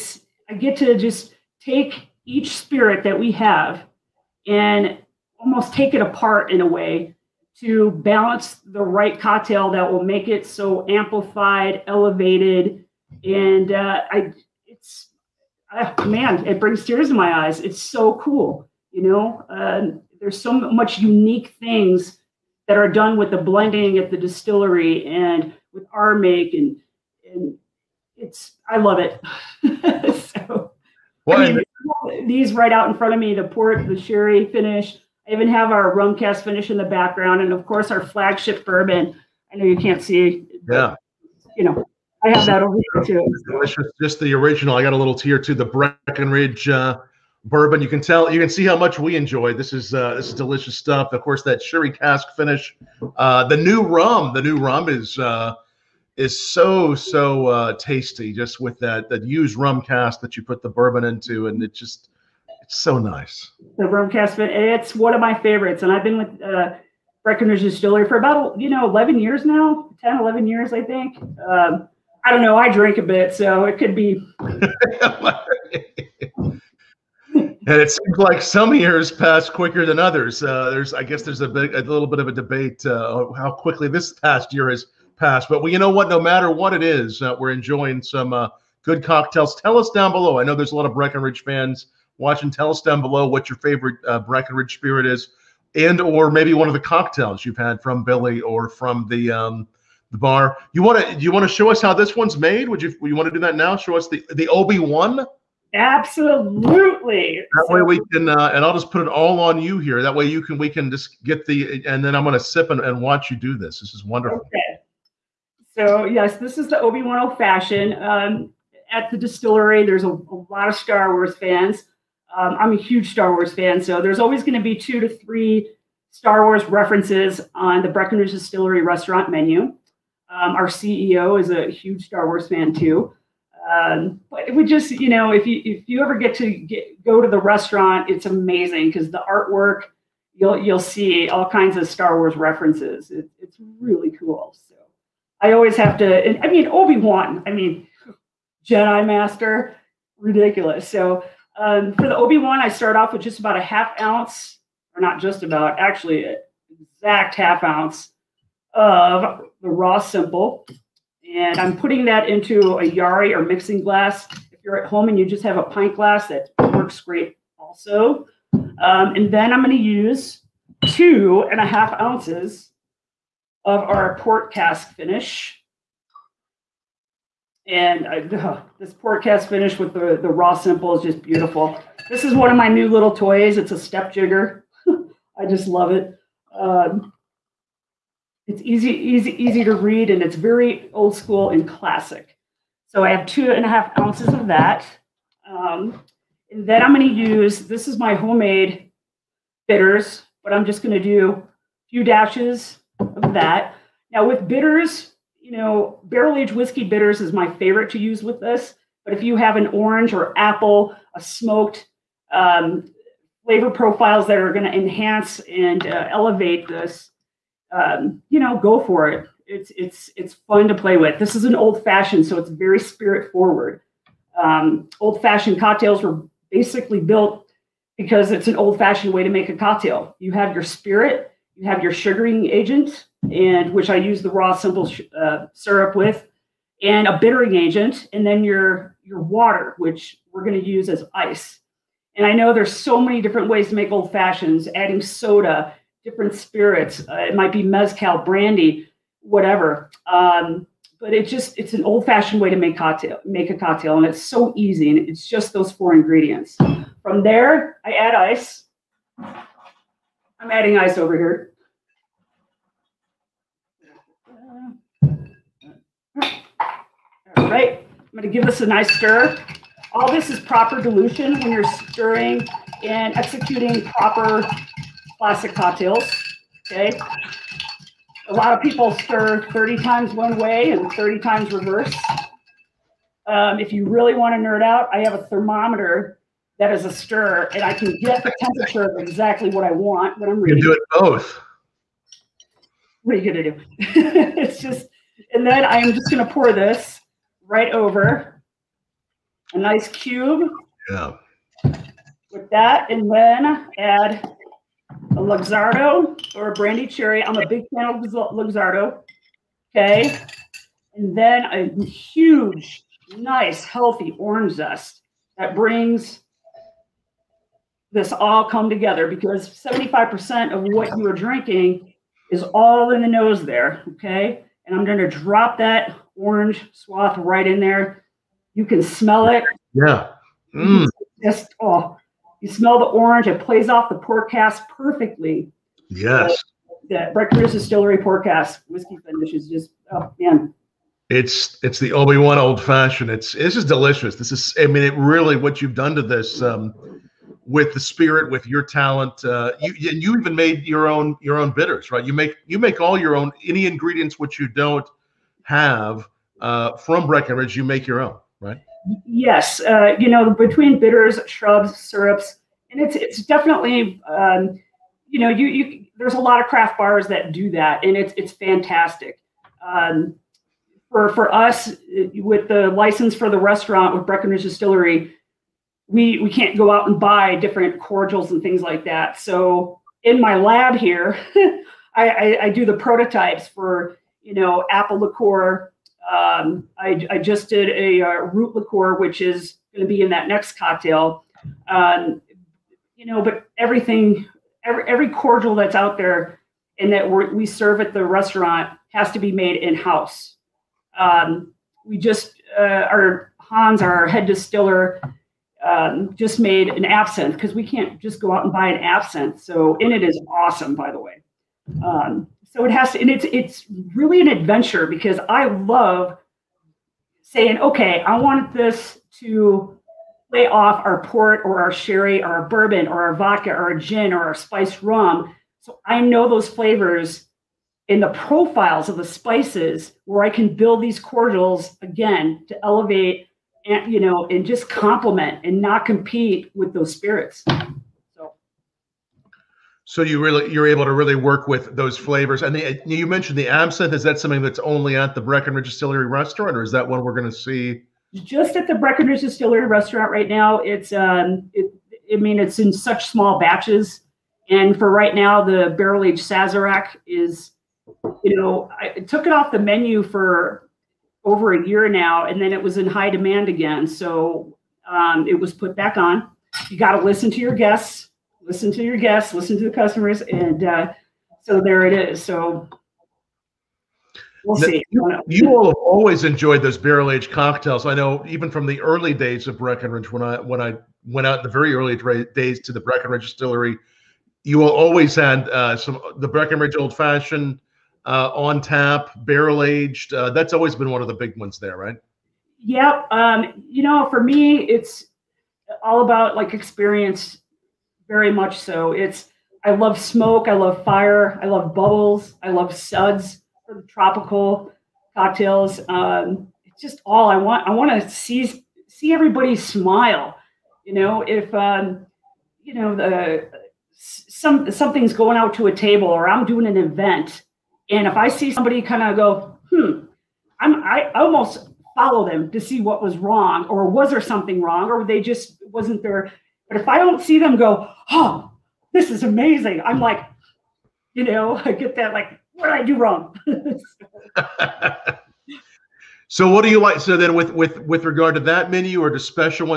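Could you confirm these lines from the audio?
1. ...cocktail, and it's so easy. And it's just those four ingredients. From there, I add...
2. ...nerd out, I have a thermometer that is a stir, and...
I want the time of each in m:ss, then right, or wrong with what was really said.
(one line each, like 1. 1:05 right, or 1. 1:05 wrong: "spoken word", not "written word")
1. 4:13 right
2. 4:44 right.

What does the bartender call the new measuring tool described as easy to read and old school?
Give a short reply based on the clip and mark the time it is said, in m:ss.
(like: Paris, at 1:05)
step jigger, at 3:03.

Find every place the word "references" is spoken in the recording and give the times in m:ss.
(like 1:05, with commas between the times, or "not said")
2:06, 2:22.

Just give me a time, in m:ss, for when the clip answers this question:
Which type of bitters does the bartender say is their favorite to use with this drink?
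3:26.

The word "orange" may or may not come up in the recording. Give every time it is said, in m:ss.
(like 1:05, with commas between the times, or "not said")
3:29, 5:14, 5:26, 5:32.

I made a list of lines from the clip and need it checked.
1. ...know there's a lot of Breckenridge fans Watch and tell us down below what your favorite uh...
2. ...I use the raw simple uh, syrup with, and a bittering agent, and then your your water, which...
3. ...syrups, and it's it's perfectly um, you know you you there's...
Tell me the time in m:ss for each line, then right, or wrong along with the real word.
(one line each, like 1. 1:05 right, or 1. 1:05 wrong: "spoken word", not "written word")
1. 1:30 right
2. 3:53 right
3. 6:01 wrong: "definitely", not "perfectly".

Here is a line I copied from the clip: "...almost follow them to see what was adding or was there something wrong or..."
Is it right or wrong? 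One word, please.
wrong.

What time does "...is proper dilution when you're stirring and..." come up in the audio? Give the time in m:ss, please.
4:30.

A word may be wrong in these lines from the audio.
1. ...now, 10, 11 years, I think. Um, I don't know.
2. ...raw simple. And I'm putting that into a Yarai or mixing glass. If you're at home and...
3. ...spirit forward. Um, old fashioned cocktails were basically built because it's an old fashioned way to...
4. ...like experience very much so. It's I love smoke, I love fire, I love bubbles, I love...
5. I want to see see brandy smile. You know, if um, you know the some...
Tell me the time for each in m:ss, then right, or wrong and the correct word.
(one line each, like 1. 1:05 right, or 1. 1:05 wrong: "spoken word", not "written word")
1. 1:09 right
2. 2:39 right
3. 3:42 right
4. 8:16 right
5. 8:27 wrong: "everybody", not "brandy".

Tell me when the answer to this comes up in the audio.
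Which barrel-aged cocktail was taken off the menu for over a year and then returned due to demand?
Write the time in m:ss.
7:36.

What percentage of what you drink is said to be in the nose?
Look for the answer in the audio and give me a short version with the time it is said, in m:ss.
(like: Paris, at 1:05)
75%, at 5:19.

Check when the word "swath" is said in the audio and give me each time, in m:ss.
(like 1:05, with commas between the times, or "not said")
5:26.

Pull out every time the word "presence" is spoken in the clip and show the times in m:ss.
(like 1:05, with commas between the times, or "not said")
not said.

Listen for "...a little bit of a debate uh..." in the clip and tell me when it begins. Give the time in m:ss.
1:21.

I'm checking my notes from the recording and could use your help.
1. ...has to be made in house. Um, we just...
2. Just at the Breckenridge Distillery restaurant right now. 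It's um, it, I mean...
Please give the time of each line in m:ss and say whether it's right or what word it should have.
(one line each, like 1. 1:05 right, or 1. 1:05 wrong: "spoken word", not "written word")
1. 6:38 right
2. 7:28 right.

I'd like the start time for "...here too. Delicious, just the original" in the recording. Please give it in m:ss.
0:42.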